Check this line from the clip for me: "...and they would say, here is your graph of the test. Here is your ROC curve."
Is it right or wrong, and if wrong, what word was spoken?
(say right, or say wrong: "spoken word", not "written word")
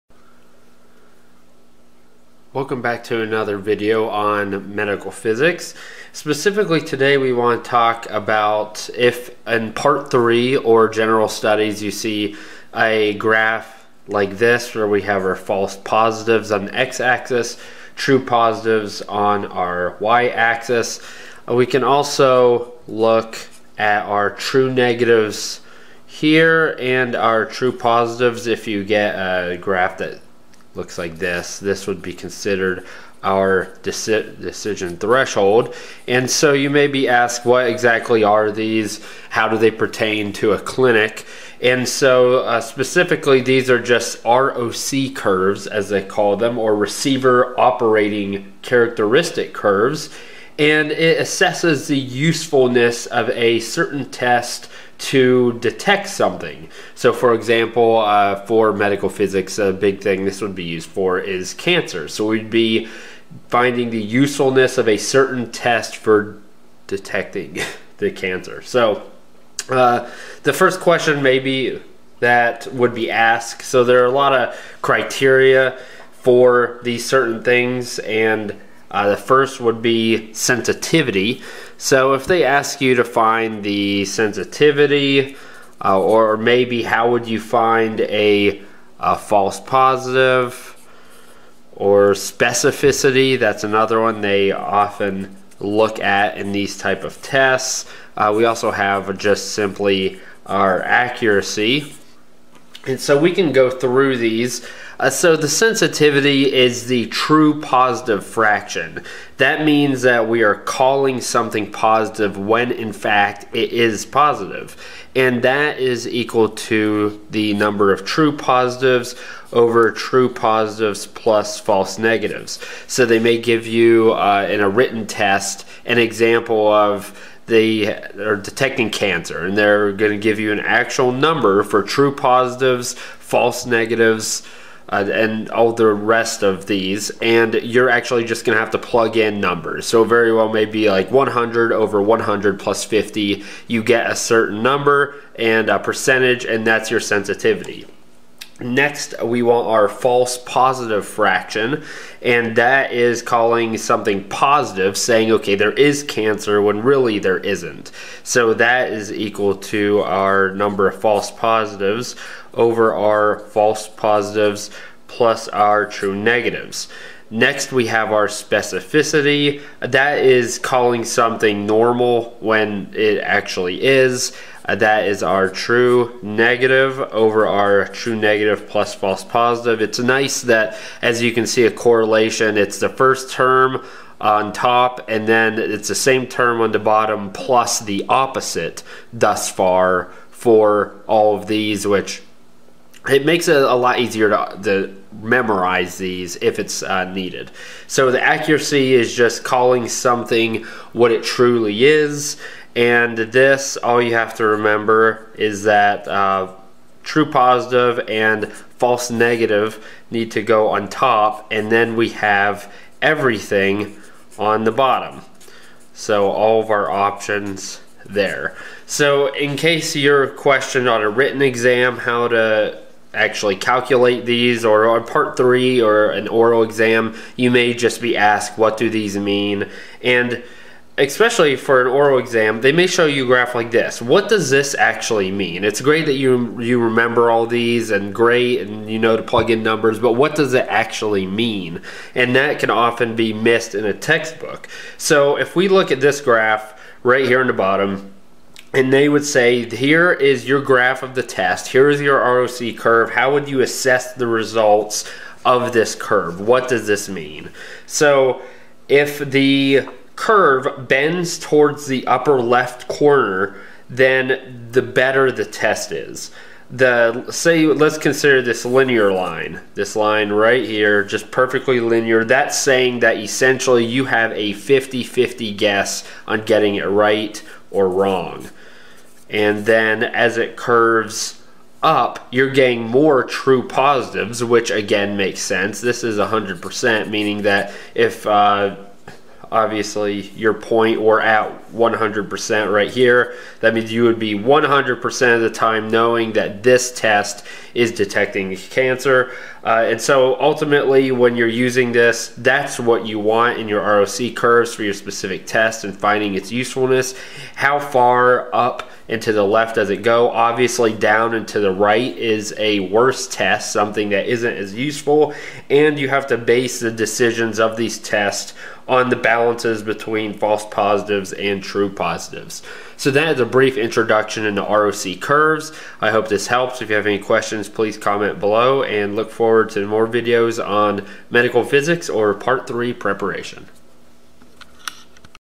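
right.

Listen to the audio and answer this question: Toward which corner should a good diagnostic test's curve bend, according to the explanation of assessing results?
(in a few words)
upper left corner.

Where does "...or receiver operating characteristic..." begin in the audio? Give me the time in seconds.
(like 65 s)
46 s.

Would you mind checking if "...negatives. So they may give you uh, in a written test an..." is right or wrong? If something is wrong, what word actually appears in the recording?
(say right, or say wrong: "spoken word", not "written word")
right.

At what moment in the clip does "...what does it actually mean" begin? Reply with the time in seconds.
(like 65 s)
240 s.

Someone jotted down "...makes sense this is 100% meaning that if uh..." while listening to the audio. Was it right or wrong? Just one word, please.
right.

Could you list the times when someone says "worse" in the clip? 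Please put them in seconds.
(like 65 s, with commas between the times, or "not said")
312 s.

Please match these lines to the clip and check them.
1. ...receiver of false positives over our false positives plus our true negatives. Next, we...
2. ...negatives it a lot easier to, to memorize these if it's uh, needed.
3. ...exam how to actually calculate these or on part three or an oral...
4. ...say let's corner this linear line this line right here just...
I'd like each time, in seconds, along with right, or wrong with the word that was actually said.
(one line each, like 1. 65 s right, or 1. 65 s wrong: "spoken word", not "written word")
1. 160 s wrong: "number", not "receiver"
2. 193 s wrong: "makes", not "negatives"
3. 221 s right
4. 267 s wrong: "consider", not "corner".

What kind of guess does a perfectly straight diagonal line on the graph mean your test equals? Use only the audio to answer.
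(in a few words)
50-50 guess.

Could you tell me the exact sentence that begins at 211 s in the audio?
And then we have everything on the bottom.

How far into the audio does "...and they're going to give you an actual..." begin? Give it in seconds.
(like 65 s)
129 s.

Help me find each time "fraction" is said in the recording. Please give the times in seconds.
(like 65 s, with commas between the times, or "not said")
108 s, 151 s.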